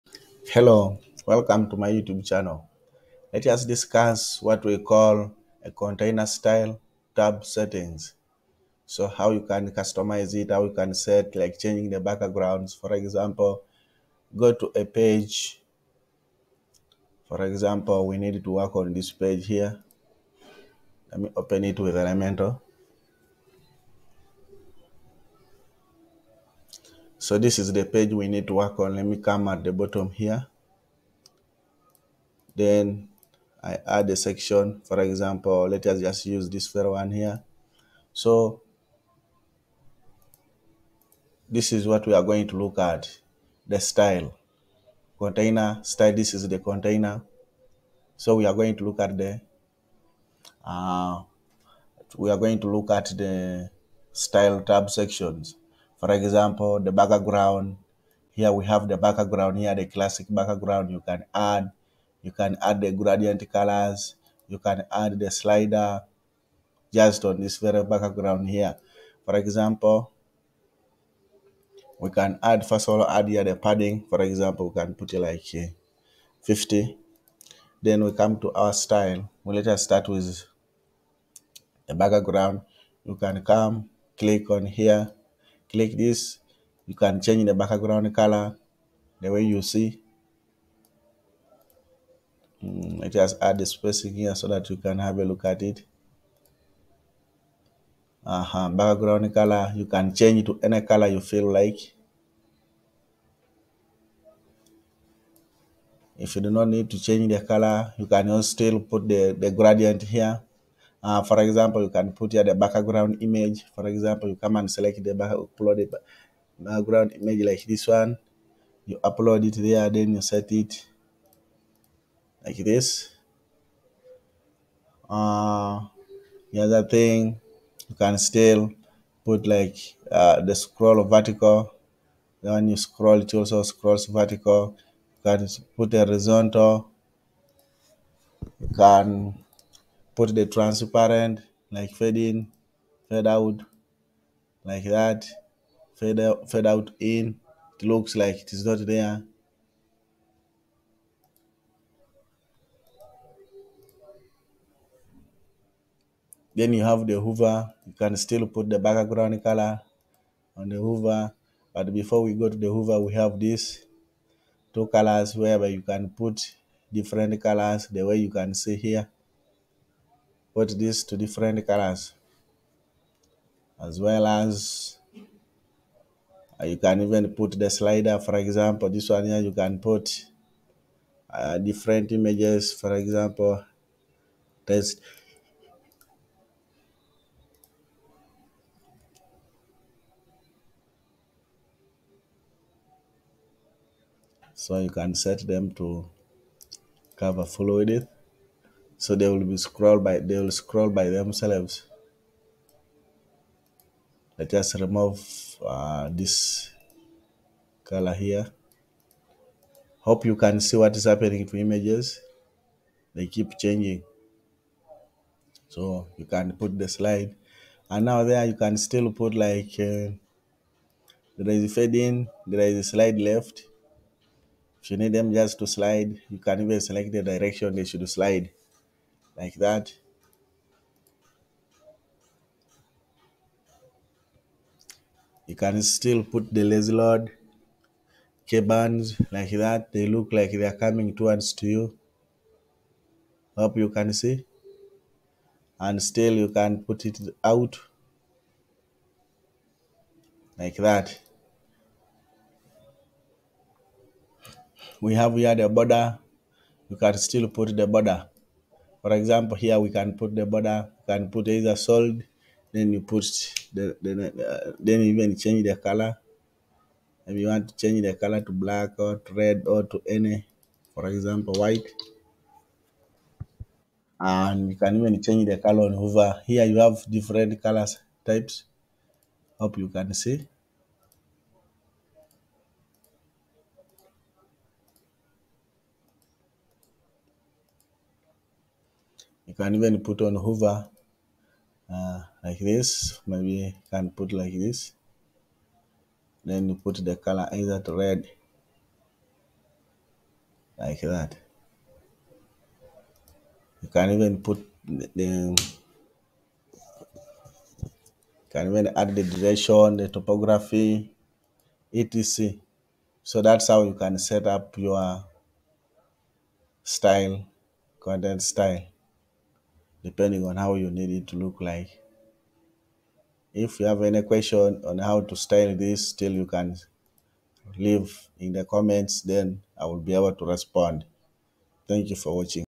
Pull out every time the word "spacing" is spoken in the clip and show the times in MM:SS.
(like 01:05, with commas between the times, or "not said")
01:33.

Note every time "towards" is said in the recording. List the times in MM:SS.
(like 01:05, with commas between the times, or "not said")
04:01.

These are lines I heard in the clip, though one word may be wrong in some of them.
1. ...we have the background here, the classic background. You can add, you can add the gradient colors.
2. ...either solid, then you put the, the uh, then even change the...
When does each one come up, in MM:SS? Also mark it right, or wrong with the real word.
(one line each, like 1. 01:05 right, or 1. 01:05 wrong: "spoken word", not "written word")
1. 00:58 right
2. 04:21 right.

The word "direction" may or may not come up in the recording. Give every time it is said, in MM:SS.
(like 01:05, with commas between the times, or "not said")
03:47, 05:09.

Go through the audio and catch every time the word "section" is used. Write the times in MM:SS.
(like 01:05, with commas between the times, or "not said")
00:34, 00:54.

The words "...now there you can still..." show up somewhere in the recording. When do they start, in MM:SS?
03:38.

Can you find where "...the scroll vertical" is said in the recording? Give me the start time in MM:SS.
02:10.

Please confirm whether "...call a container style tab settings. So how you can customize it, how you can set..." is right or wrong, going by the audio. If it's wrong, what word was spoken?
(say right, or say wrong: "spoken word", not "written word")
right.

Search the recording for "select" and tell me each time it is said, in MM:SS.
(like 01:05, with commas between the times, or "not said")
01:54, 03:46.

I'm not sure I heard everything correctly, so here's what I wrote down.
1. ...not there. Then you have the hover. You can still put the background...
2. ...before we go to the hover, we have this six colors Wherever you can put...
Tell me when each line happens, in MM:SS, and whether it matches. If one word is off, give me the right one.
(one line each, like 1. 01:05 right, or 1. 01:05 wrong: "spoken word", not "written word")
1. 02:28 right
2. 02:41 wrong: "two", not "six".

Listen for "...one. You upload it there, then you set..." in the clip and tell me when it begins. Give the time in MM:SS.
01:57.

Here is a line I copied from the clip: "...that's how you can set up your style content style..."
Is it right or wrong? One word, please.
right.